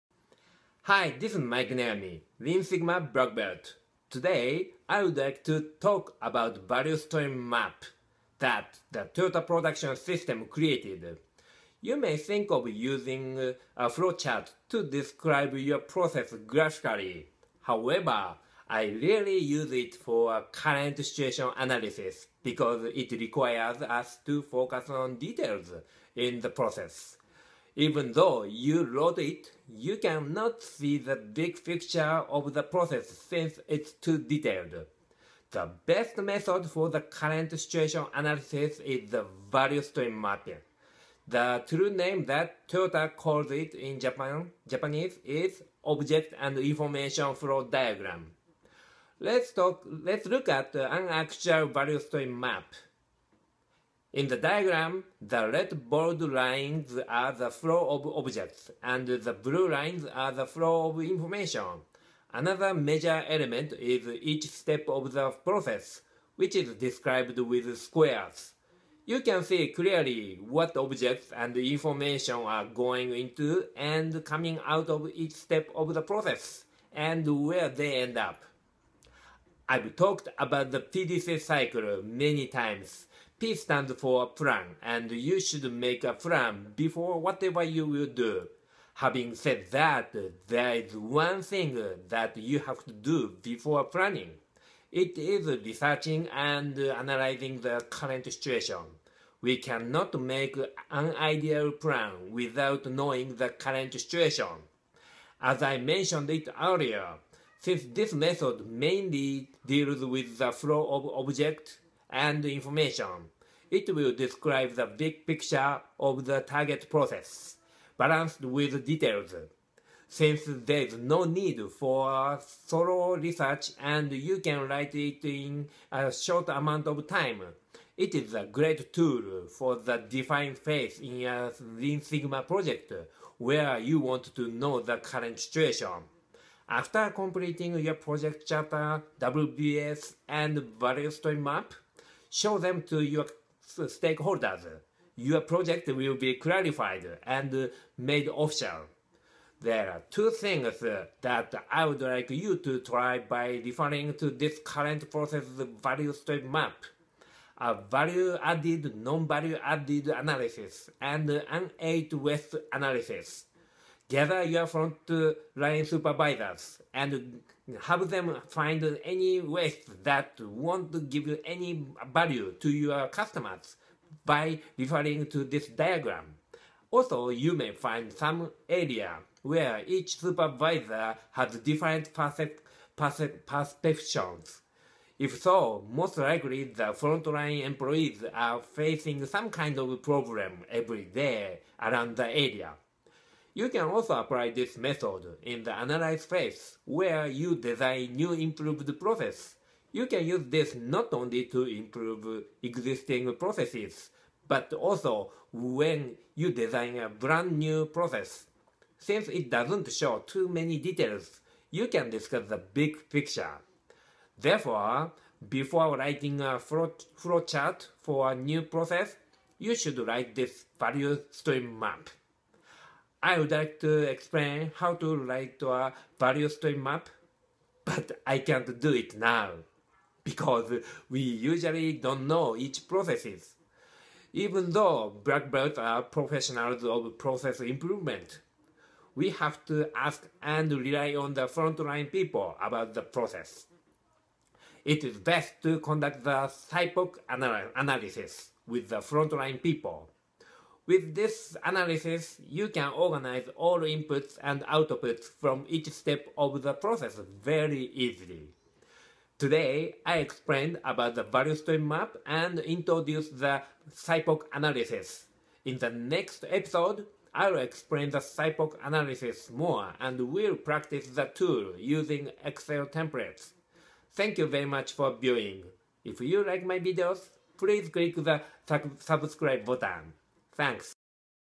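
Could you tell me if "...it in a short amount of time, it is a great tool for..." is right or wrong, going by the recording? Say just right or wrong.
right.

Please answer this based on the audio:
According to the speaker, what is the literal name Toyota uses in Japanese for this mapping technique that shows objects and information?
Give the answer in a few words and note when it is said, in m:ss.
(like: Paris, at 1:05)
Object and information flow diagram, at 0:45.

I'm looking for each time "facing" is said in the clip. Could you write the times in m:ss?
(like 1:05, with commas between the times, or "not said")
3:08.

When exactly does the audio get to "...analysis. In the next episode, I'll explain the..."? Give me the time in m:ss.
4:24.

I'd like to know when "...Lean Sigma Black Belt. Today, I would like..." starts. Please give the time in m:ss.
0:02.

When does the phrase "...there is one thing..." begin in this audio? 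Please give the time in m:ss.
1:30.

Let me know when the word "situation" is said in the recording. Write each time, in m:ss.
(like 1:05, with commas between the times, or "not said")
0:20, 0:37, 1:38, 1:43, 2:15.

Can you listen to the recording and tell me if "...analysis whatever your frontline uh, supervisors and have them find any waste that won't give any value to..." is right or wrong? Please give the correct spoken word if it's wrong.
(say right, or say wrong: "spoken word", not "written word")
wrong: "gather", not "whatever".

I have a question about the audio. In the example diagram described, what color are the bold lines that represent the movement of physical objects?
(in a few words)
Red.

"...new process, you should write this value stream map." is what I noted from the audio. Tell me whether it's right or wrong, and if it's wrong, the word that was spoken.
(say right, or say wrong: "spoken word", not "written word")
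right.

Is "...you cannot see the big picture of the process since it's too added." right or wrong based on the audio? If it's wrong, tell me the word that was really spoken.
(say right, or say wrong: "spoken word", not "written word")
wrong: "detailed", not "added".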